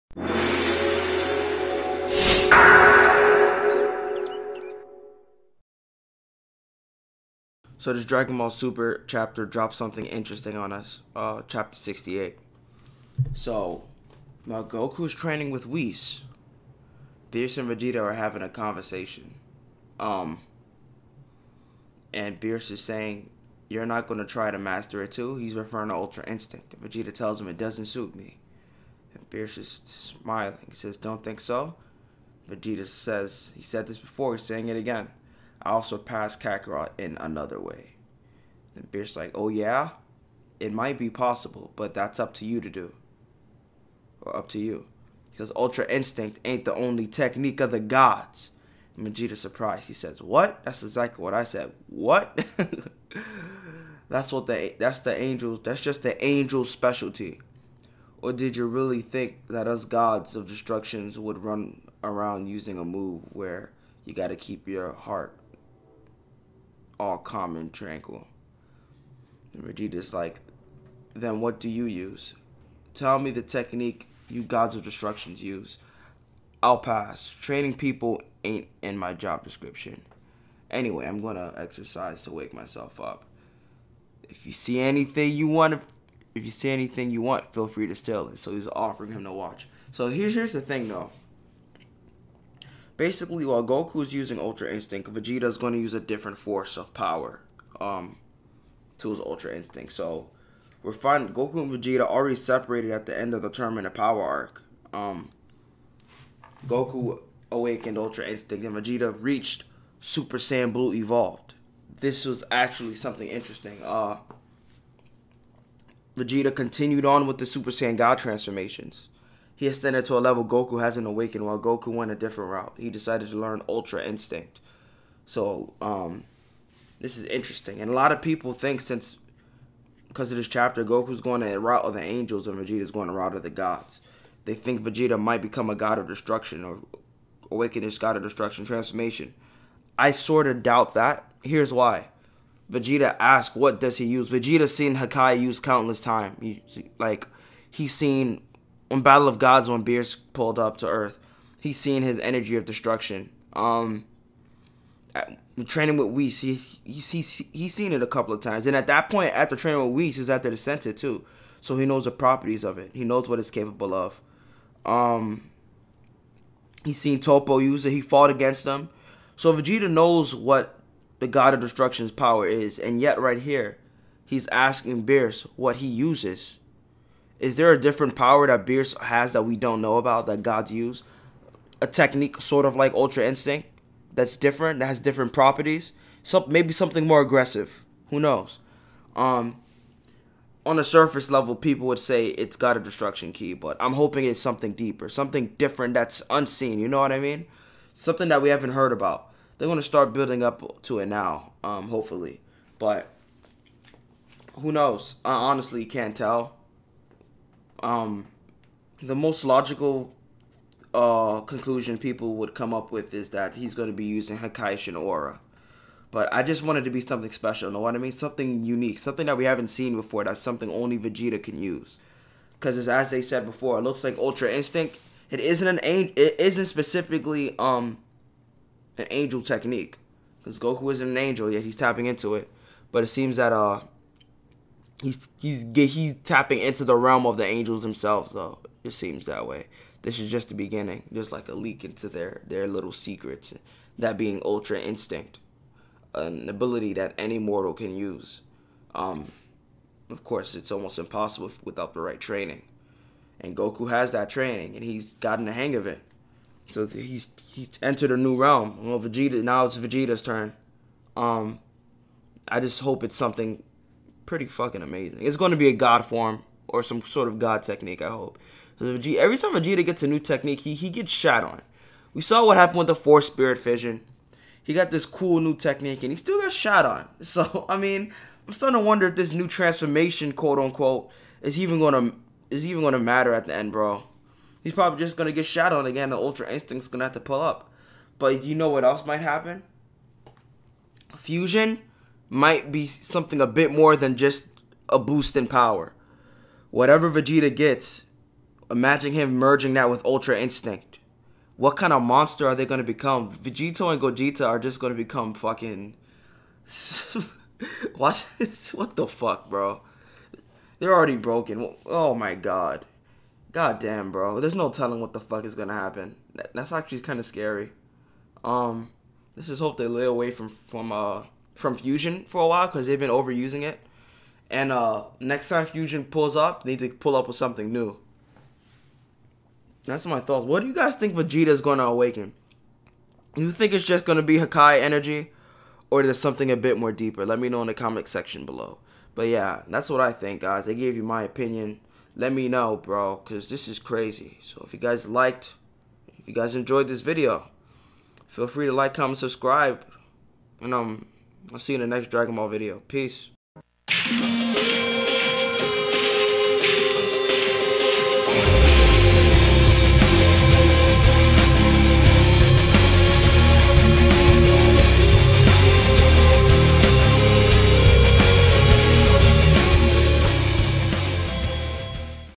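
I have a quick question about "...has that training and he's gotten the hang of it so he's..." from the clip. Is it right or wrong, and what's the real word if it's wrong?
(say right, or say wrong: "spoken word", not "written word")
right.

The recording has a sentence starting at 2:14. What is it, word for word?
They think Vegeta might become a god of destruction or awaken his god of destruction transformation.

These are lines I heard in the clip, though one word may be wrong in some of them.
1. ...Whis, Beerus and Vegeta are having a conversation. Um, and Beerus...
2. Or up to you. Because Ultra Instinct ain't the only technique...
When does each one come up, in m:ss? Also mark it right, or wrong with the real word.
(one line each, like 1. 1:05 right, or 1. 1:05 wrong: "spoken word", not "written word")
1. 0:15 right
2. 0:44 right.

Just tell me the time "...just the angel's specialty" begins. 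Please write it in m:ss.
0:55.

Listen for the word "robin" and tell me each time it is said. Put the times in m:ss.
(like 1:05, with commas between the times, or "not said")
not said.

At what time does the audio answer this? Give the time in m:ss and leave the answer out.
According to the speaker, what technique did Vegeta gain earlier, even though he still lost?
4:32.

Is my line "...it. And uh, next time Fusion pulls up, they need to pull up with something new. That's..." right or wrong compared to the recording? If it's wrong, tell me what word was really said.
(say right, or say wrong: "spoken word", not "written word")
right.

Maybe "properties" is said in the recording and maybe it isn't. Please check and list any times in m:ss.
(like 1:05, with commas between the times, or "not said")
2:42, 3:05.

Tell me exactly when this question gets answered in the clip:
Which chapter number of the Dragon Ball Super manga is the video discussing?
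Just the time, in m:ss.
0:11.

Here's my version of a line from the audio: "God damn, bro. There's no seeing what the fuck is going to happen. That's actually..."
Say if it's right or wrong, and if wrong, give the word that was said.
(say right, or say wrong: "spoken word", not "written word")
wrong: "telling", not "seeing".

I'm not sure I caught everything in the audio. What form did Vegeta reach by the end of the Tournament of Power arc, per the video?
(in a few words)
Super Saiyan Blue Evolved.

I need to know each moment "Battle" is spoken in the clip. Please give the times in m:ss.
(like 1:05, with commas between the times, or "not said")
2:29.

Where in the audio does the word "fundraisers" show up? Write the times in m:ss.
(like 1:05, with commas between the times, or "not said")
not said.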